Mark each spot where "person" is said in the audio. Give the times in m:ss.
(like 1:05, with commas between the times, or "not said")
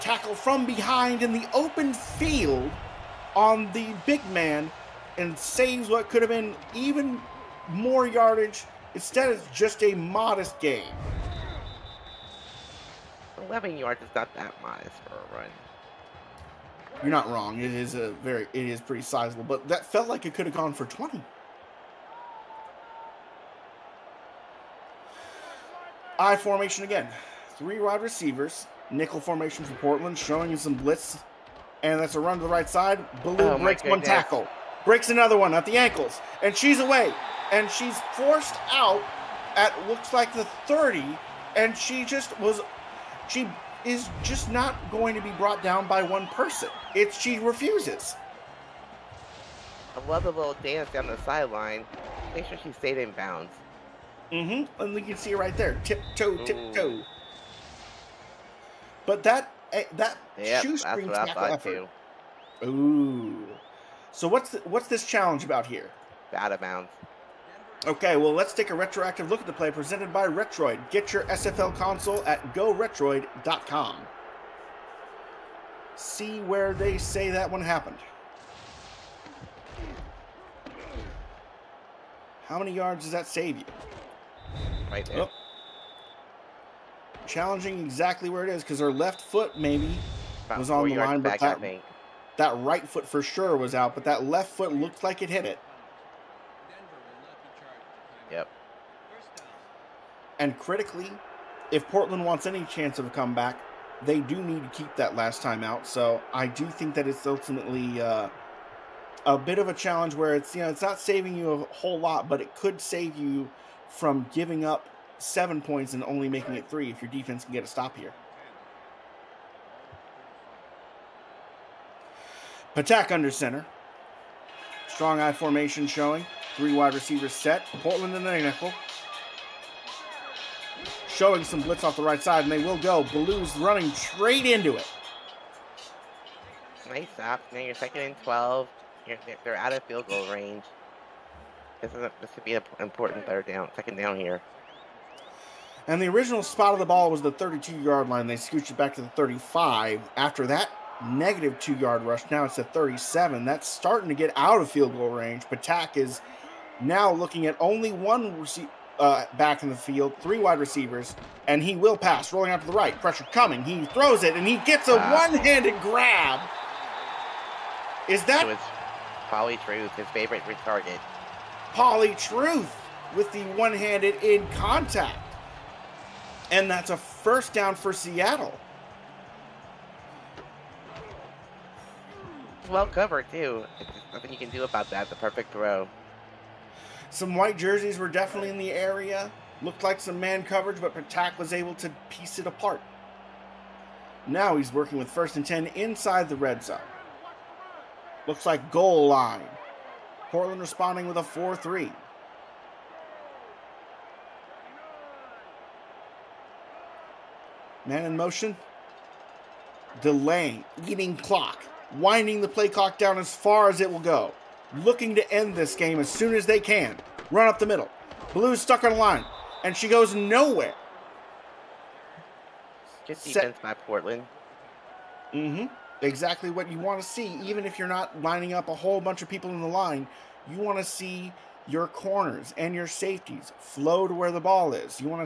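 0:46.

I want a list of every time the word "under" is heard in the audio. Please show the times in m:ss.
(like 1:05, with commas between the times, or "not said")
2:03.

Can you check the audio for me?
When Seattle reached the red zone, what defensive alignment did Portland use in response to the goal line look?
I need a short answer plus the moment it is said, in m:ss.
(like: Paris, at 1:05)
4-3, at 3:21.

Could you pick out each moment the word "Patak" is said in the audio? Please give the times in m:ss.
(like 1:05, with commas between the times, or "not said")
2:02, 2:35, 3:10.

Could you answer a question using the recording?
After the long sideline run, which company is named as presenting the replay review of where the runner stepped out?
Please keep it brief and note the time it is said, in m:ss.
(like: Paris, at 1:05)
Retroid, at 1:10.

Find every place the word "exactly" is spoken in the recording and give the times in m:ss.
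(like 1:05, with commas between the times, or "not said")
1:27, 3:46.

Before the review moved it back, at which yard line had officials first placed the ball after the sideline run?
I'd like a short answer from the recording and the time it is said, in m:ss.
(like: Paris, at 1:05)
32, at 2:27.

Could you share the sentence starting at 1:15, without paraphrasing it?
See where they say that one happened.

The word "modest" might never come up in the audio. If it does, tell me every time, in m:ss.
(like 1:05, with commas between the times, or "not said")
0:09, 0:14.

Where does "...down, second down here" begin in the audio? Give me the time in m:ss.
2:23.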